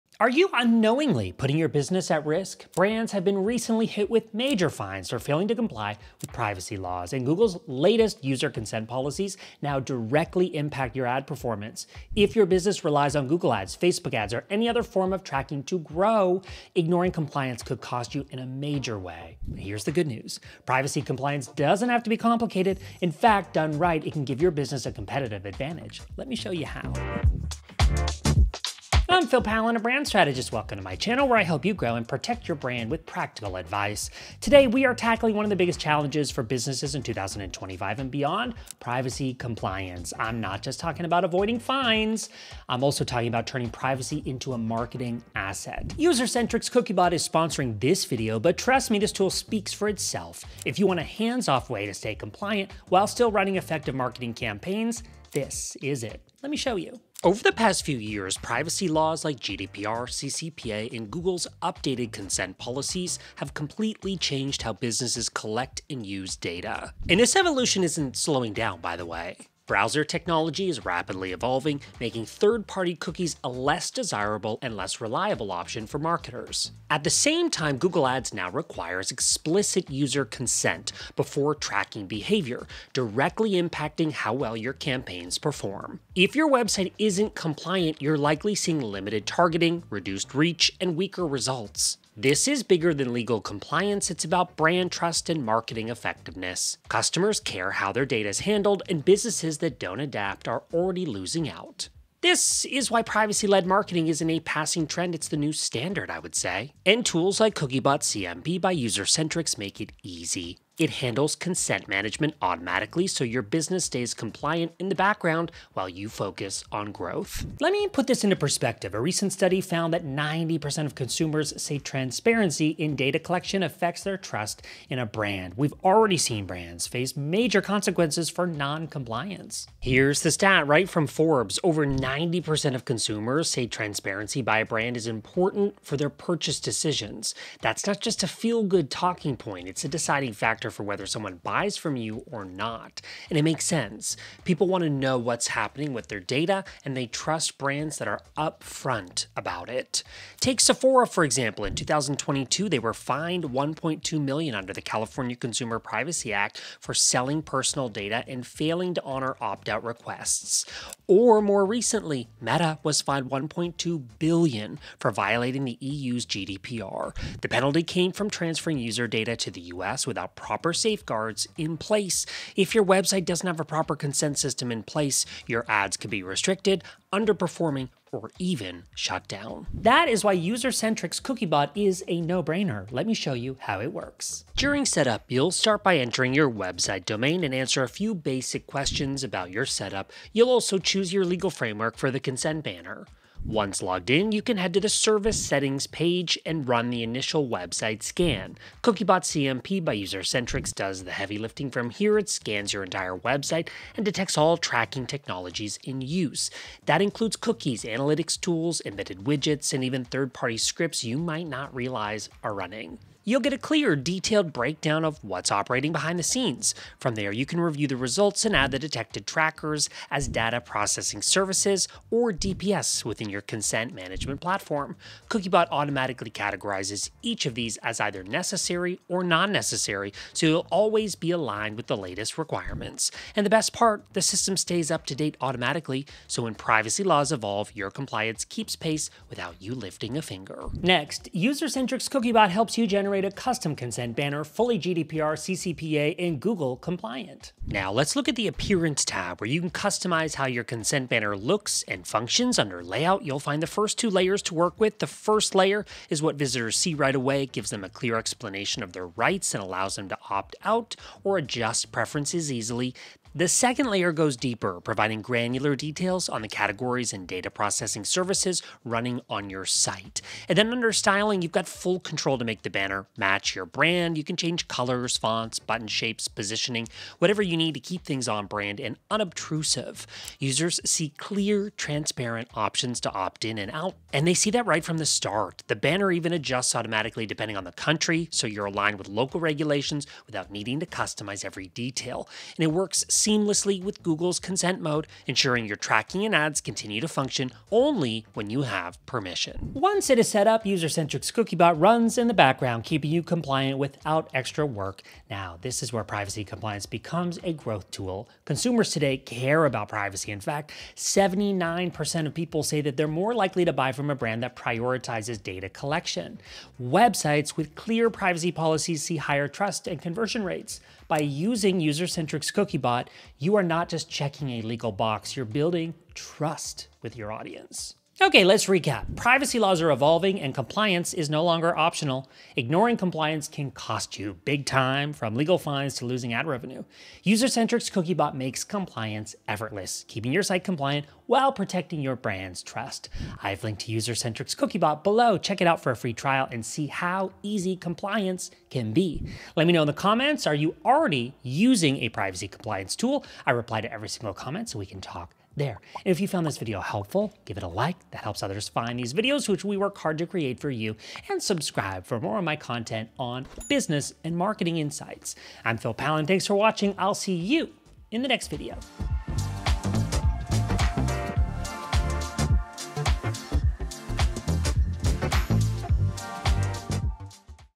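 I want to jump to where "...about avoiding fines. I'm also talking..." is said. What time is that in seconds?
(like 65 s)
41 s.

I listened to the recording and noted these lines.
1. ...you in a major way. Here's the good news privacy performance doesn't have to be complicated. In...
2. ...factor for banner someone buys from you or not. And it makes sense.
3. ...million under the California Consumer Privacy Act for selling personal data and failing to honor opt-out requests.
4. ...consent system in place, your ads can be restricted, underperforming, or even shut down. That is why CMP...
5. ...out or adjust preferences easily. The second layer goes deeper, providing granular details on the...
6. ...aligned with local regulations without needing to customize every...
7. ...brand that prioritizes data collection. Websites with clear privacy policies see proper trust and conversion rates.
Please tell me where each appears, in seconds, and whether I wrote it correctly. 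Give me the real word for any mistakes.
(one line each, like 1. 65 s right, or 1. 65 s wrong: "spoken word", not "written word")
1. 18 s wrong: "compliance", not "performance"
2. 140 s wrong: "whether", not "banner"
3. 154 s right
4. 173 s wrong: "Usercentrics", not "CMP"
5. 260 s right
6. 288 s right
7. 314 s wrong: "higher", not "proper".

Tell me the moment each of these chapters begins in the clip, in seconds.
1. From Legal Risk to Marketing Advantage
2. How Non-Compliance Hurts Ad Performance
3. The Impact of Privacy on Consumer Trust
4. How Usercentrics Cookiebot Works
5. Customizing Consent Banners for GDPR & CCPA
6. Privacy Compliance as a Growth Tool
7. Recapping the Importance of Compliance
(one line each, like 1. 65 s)
1. 38 s
2. 86 s
3. 118 s
4. 182 s
5. 240 s
6. 299 s
7. 327 s.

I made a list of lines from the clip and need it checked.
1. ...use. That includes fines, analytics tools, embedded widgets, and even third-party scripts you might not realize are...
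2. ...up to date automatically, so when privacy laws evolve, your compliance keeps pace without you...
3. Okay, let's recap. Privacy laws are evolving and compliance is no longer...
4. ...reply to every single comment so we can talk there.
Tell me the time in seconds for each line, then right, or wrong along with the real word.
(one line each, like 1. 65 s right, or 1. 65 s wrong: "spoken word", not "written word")
1. 206 s wrong: "cookies", not "fines"
2. 234 s right
3. 328 s right
4. 353 s right.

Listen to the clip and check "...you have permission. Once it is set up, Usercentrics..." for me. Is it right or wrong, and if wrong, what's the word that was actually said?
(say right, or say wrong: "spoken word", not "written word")
right.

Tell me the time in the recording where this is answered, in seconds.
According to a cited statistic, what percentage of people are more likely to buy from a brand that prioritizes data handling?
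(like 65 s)
310 s.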